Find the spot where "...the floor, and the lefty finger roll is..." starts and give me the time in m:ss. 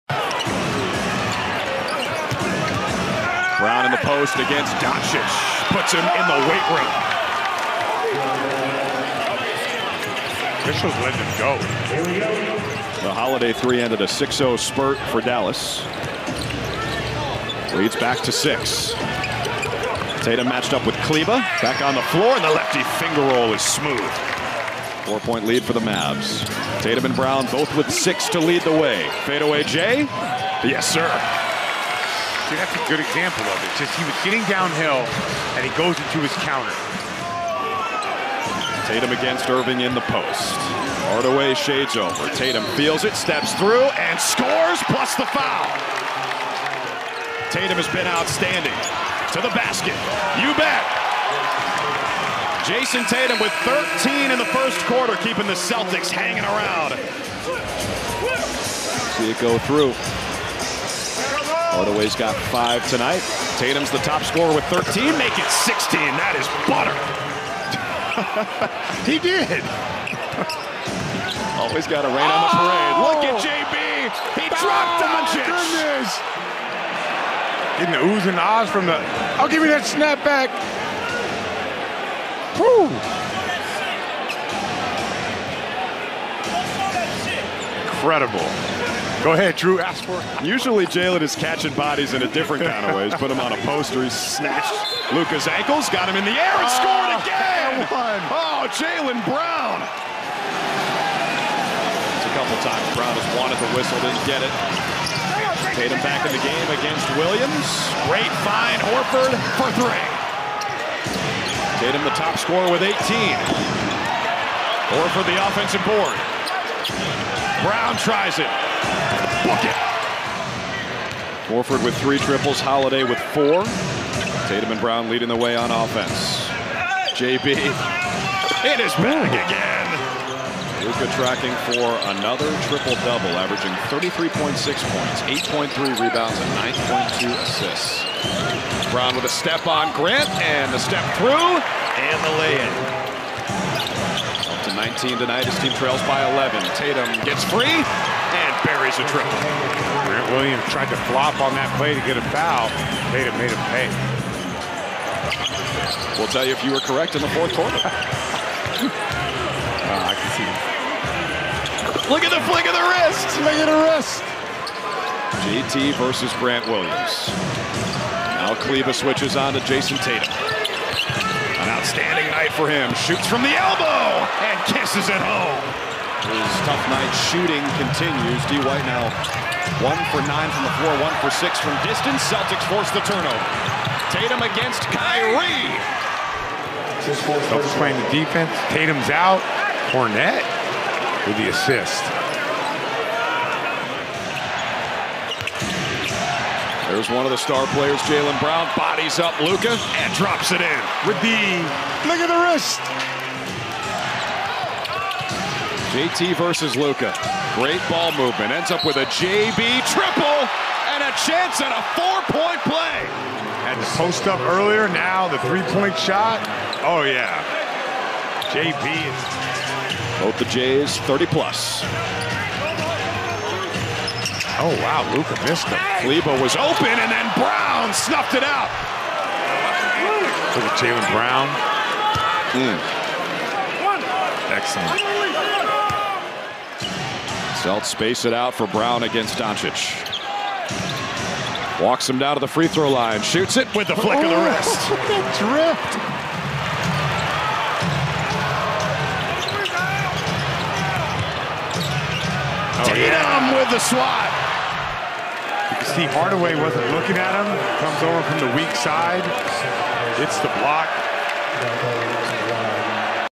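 0:21.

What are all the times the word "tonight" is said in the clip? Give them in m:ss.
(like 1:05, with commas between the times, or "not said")
1:02, 2:25.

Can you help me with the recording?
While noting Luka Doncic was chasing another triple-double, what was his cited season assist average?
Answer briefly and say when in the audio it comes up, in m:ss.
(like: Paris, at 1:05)
9.2, at 2:17.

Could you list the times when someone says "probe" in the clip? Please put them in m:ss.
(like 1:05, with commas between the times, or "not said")
not said.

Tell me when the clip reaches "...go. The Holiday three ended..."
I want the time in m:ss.
0:11.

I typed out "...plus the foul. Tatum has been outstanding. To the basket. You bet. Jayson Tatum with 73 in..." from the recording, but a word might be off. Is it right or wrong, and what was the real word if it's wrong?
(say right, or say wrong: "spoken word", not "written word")
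wrong: "13", not "73".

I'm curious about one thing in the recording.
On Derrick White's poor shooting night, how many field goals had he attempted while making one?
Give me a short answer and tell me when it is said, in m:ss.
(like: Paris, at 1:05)
9, at 2:59.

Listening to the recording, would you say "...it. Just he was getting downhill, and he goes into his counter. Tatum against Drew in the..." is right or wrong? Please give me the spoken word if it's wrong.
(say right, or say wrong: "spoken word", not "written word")
wrong: "Irving", not "Drew".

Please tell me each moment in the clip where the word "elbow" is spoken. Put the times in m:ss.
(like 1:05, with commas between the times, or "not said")
2:53.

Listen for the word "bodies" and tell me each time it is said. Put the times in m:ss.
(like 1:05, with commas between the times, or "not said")
1:31, 3:18.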